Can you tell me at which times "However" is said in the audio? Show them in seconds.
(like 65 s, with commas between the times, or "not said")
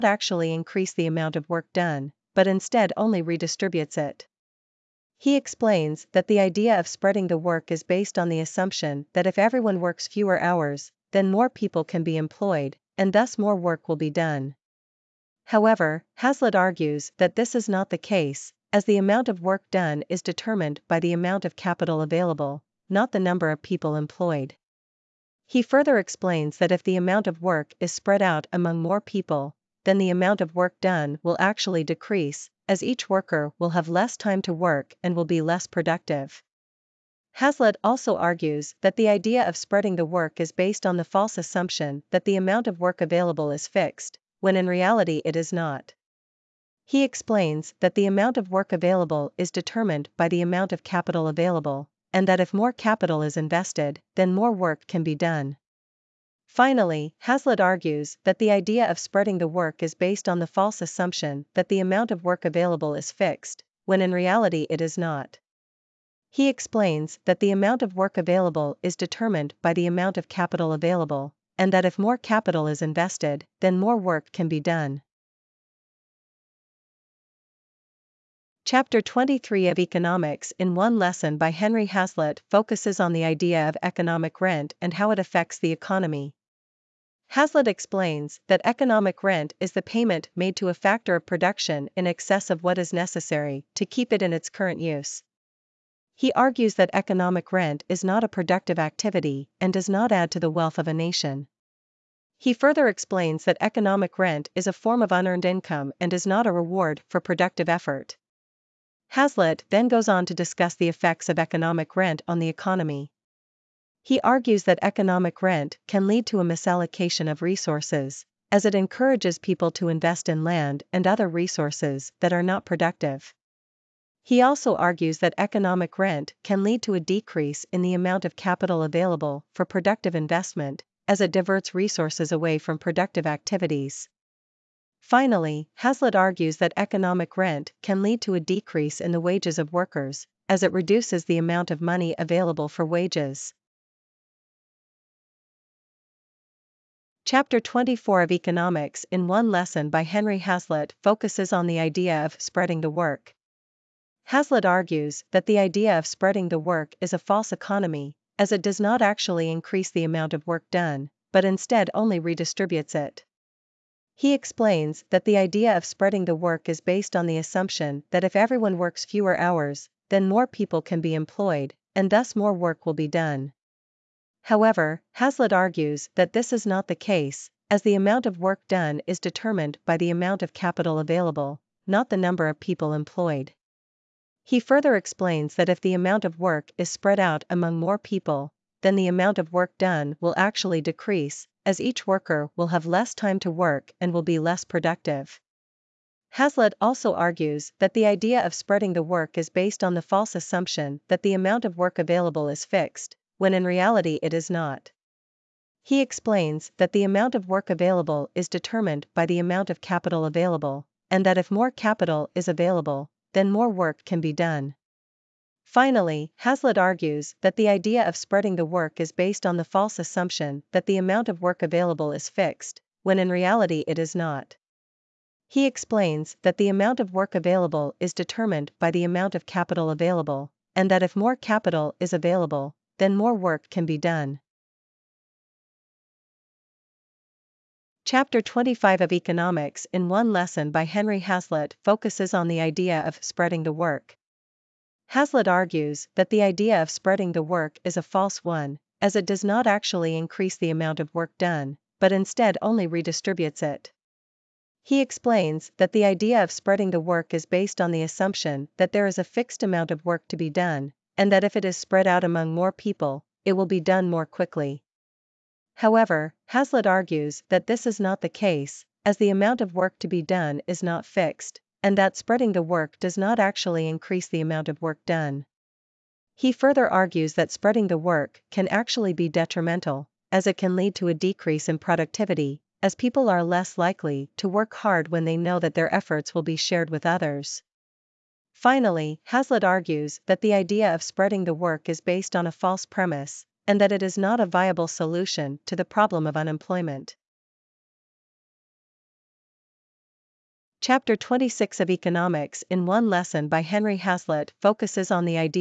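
15 s, 174 s, 265 s.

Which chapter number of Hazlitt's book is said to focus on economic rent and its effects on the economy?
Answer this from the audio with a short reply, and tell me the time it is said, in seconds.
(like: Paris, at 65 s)
23, at 78 s.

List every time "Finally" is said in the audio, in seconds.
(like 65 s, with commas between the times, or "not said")
56 s, 135 s, 215 s, 288 s.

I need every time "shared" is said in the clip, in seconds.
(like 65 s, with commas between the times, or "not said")
286 s.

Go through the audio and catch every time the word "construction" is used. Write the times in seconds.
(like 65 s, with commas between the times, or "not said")
not said.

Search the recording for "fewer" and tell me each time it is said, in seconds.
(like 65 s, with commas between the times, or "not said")
10 s, 169 s.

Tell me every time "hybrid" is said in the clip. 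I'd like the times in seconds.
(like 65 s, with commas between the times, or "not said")
not said.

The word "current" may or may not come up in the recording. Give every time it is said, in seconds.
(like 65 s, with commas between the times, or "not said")
94 s.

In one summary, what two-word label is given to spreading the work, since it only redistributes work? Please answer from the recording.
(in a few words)
false economy.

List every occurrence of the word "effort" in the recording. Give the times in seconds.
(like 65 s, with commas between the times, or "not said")
107 s, 285 s.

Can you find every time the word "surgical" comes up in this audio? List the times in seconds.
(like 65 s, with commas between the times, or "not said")
not said.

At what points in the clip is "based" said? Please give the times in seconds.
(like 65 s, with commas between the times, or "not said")
7 s, 40 s, 59 s, 166 s, 199 s, 219 s, 257 s, 292 s.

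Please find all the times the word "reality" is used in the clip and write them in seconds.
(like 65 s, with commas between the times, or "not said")
44 s, 64 s, 203 s, 223 s.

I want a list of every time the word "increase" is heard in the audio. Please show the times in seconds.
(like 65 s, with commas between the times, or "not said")
0 s, 159 s, 250 s, 273 s.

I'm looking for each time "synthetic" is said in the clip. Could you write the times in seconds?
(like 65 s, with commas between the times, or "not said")
not said.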